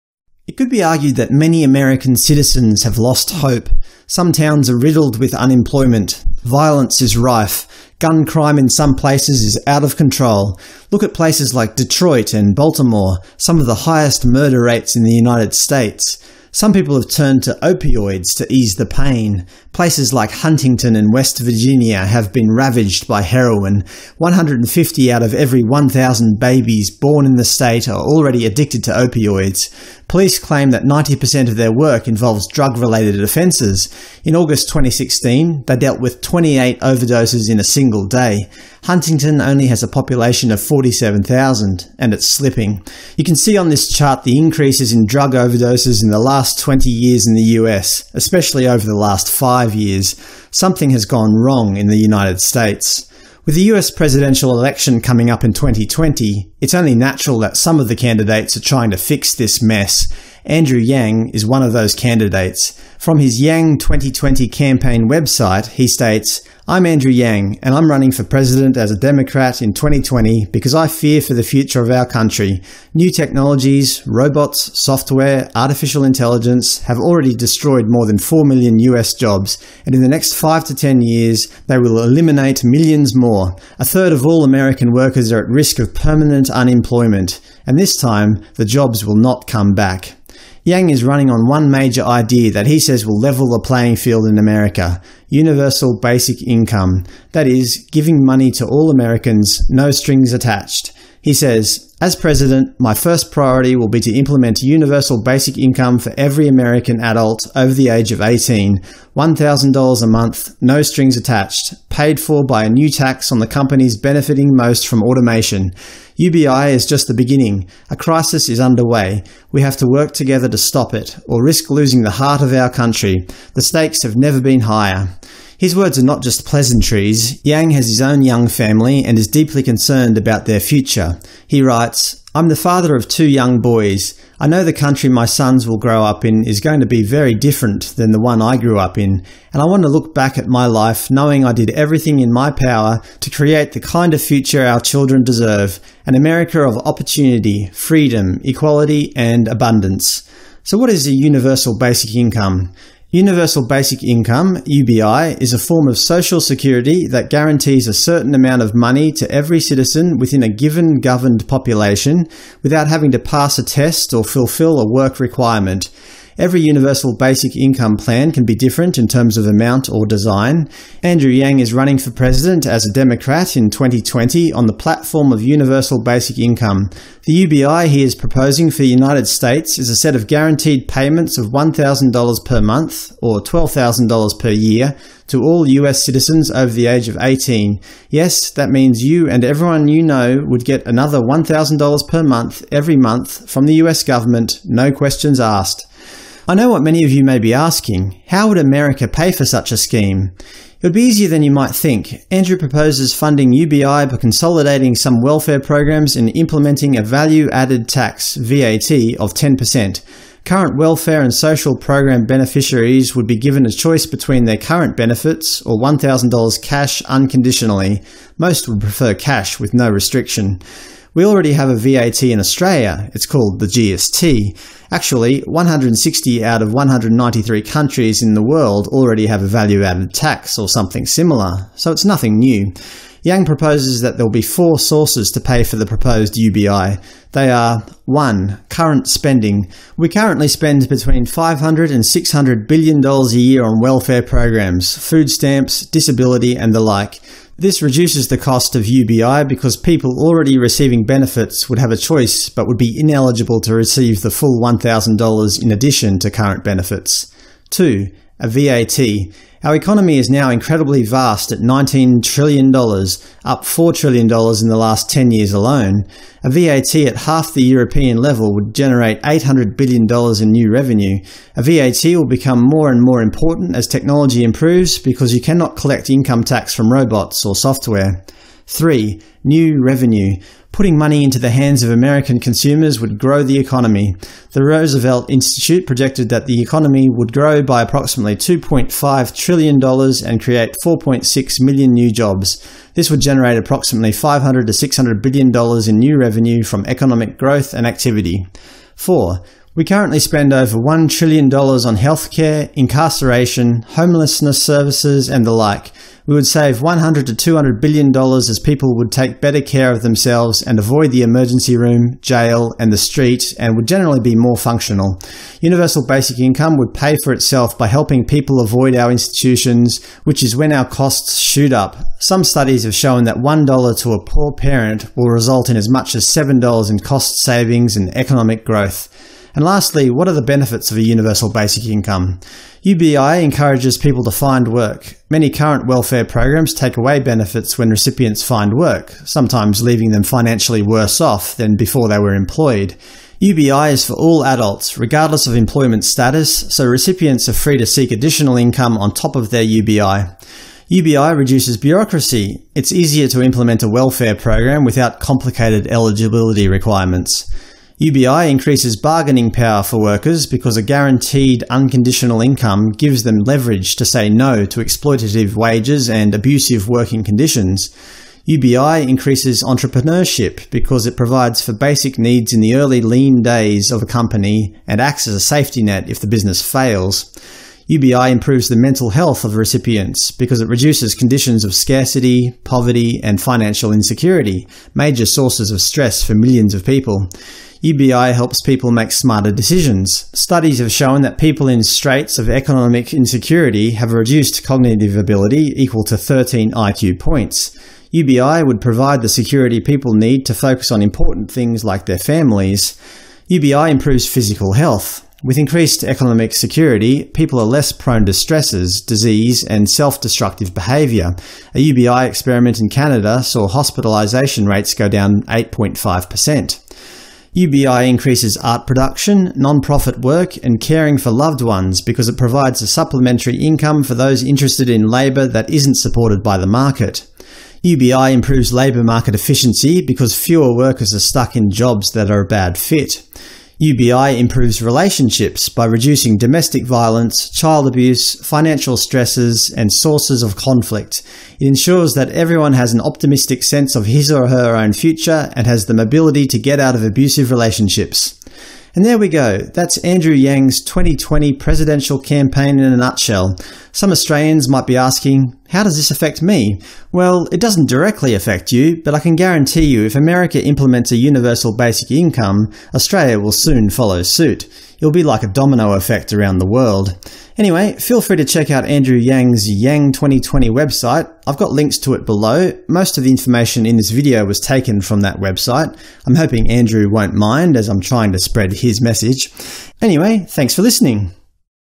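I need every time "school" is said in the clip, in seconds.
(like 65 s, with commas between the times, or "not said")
not said.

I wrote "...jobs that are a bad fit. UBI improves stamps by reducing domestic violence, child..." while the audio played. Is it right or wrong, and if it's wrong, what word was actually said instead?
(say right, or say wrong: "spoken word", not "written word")
wrong: "relationships", not "stamps".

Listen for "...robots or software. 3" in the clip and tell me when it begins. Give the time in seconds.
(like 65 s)
276 s.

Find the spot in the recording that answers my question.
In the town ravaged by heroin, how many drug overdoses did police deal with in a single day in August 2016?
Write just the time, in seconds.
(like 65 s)
36 s.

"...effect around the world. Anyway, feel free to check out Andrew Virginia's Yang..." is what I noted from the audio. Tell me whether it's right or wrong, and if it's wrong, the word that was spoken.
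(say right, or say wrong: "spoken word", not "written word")
wrong: "Yang", not "Virginia".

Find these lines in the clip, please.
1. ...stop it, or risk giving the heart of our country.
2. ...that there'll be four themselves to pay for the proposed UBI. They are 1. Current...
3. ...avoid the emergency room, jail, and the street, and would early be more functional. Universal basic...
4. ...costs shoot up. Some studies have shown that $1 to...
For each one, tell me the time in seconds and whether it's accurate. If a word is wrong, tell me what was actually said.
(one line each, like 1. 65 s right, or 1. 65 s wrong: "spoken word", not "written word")
1. 120 s wrong: "losing", not "giving"
2. 233 s wrong: "sources", not "themselves"
3. 310 s wrong: "generally", not "early"
4. 320 s right.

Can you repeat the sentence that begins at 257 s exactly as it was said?
2 a VAT, our economy is now incredibly vast at $19 trillion, up $4 trillion in the last 10 years alone.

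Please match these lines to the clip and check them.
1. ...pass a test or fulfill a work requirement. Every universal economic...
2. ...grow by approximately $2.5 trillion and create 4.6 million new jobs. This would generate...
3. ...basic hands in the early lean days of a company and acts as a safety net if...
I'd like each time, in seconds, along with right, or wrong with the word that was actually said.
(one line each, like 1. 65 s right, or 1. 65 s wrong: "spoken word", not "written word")
1. 163 s wrong: "basic", not "economic"
2. 287 s right
3. 371 s wrong: "needs", not "hands".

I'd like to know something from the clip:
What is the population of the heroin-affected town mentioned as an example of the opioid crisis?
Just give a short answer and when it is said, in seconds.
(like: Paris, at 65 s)
47,000, at 40 s.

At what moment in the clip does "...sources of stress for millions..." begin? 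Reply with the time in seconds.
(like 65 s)
385 s.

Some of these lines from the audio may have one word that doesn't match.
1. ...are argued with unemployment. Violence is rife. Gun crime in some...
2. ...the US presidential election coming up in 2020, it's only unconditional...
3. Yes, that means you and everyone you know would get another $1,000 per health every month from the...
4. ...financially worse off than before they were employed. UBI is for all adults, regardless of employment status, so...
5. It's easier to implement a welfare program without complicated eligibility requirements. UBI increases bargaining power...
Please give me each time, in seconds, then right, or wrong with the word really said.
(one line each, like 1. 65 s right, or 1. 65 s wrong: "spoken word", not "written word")
1. 4 s wrong: "riddled", not "argued"
2. 53 s wrong: "natural", not "unconditional"
3. 188 s wrong: "month", not "health"
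4. 340 s right
5. 352 s right.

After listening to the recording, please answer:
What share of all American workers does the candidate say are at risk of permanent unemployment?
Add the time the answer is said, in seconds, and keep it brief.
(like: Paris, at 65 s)
A third, at 83 s.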